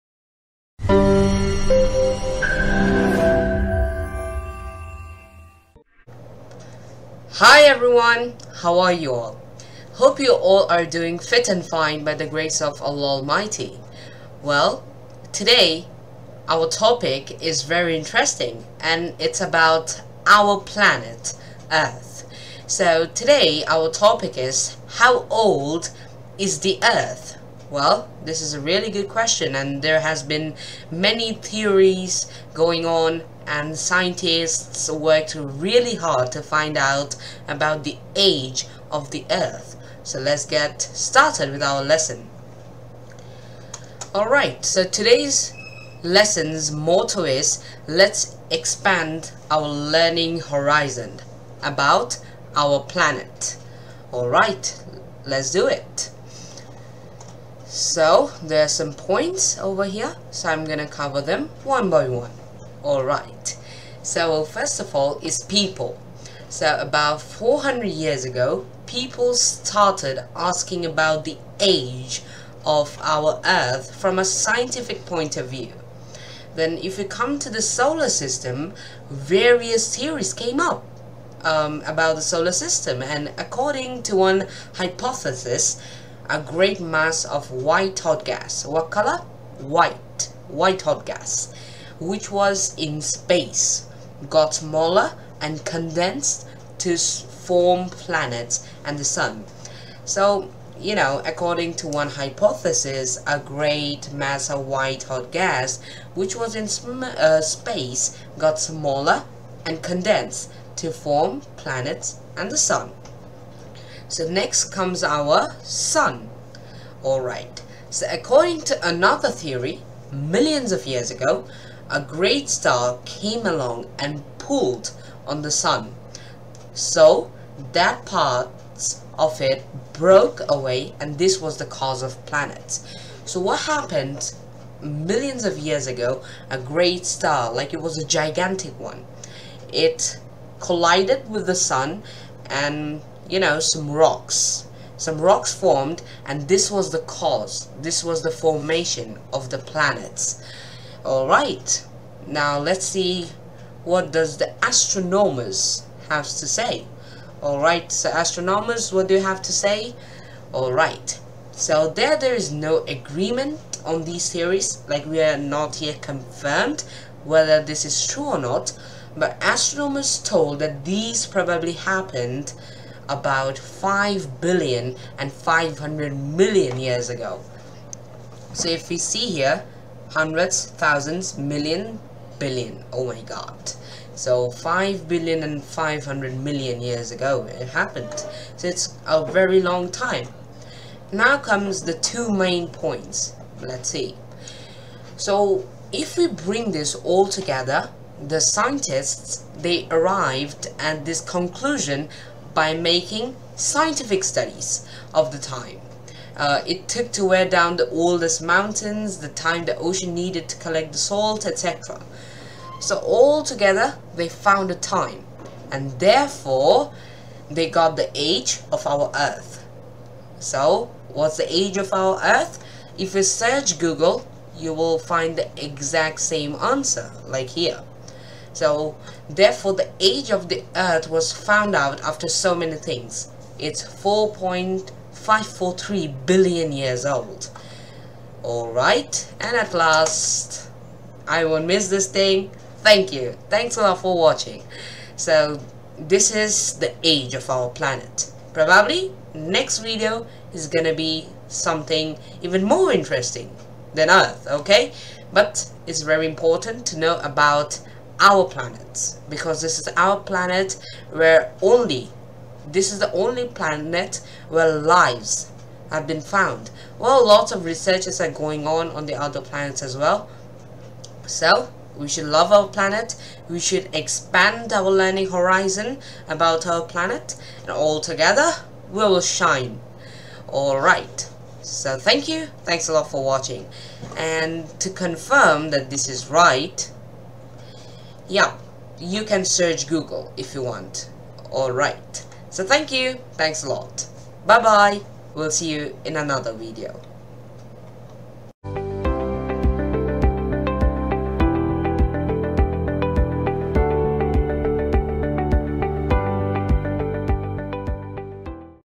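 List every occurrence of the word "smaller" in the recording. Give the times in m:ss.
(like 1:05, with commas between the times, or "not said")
1:34, 1:48.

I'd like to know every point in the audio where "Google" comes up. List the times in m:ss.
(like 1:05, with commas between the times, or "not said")
3:43, 4:49.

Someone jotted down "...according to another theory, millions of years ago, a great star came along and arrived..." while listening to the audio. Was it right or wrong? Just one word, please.
wrong.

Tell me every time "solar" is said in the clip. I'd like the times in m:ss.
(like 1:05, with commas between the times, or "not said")
1:17, 1:22.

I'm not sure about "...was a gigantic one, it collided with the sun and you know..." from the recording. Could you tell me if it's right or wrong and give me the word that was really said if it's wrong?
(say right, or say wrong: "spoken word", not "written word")
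right.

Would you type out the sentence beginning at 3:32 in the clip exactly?
So all together, they found a time, and therefore, they got the age of our Earth.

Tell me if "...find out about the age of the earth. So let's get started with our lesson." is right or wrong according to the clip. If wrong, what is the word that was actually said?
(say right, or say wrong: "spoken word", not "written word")
right.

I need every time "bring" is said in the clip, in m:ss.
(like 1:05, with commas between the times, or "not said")
3:16.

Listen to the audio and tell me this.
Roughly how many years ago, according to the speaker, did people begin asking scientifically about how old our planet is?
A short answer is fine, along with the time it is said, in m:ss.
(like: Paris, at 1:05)
400, at 1:07.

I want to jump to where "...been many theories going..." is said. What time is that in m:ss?
0:30.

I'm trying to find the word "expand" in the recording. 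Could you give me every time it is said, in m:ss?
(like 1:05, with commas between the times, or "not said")
0:48, 4:33.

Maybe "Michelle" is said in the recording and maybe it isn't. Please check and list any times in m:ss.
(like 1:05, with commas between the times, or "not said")
not said.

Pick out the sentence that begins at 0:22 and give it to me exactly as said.
So today our topic is how old is the Earth?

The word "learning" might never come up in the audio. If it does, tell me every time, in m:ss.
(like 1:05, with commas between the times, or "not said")
0:49, 4:34.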